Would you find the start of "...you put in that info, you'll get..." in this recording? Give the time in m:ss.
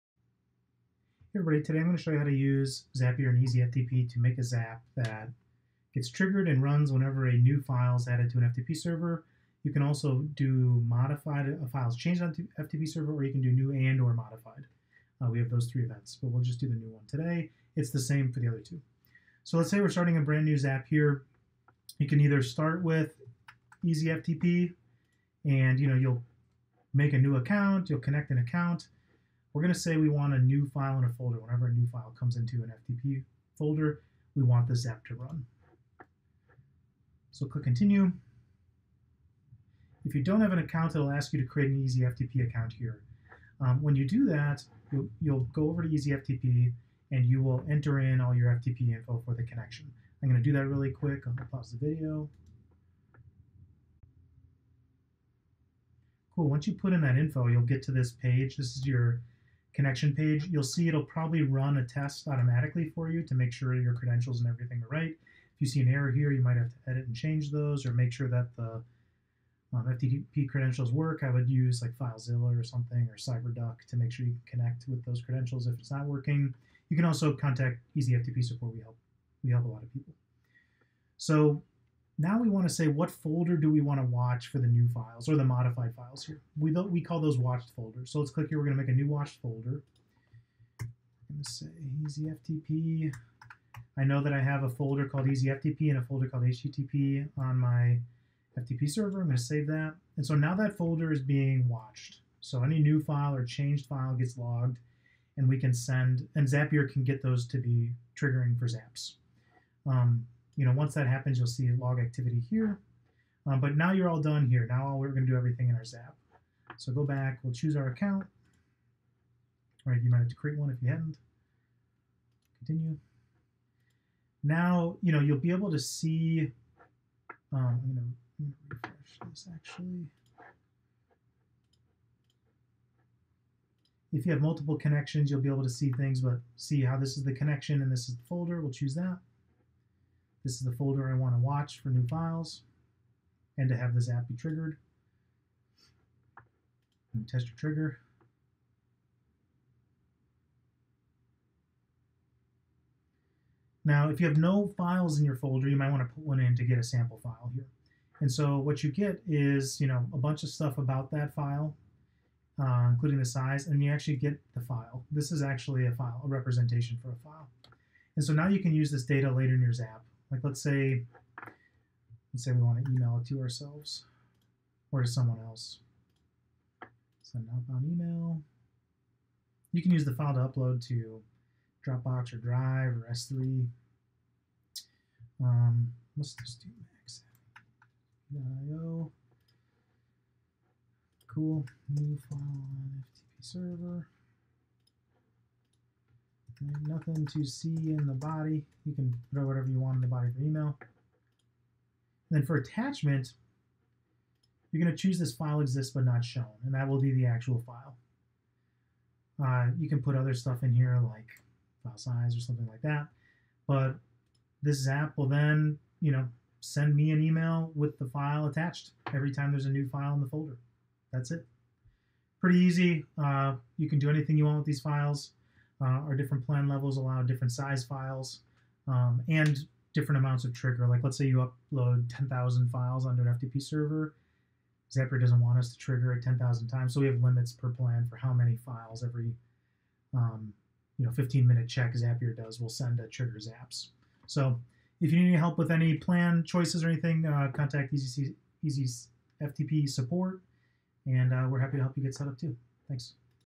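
0:56.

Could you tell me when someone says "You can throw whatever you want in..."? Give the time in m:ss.
3:18.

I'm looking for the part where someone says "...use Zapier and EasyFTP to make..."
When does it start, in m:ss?
0:02.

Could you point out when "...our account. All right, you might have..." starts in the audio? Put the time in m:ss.
1:57.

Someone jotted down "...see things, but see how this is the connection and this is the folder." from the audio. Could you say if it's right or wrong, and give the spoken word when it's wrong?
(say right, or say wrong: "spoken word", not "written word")
right.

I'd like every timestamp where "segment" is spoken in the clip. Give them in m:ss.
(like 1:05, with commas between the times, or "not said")
not said.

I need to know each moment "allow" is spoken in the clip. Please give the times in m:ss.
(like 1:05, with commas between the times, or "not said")
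3:46.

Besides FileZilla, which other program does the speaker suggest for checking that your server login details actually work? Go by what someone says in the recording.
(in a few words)
CyberDuck.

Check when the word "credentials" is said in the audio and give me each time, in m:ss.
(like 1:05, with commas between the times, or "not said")
1:03, 1:10, 1:15.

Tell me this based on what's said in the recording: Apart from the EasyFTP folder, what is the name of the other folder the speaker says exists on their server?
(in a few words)
HTTP.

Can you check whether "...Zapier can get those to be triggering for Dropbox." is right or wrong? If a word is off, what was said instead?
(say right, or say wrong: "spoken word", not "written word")
wrong: "Zaps", not "Dropbox".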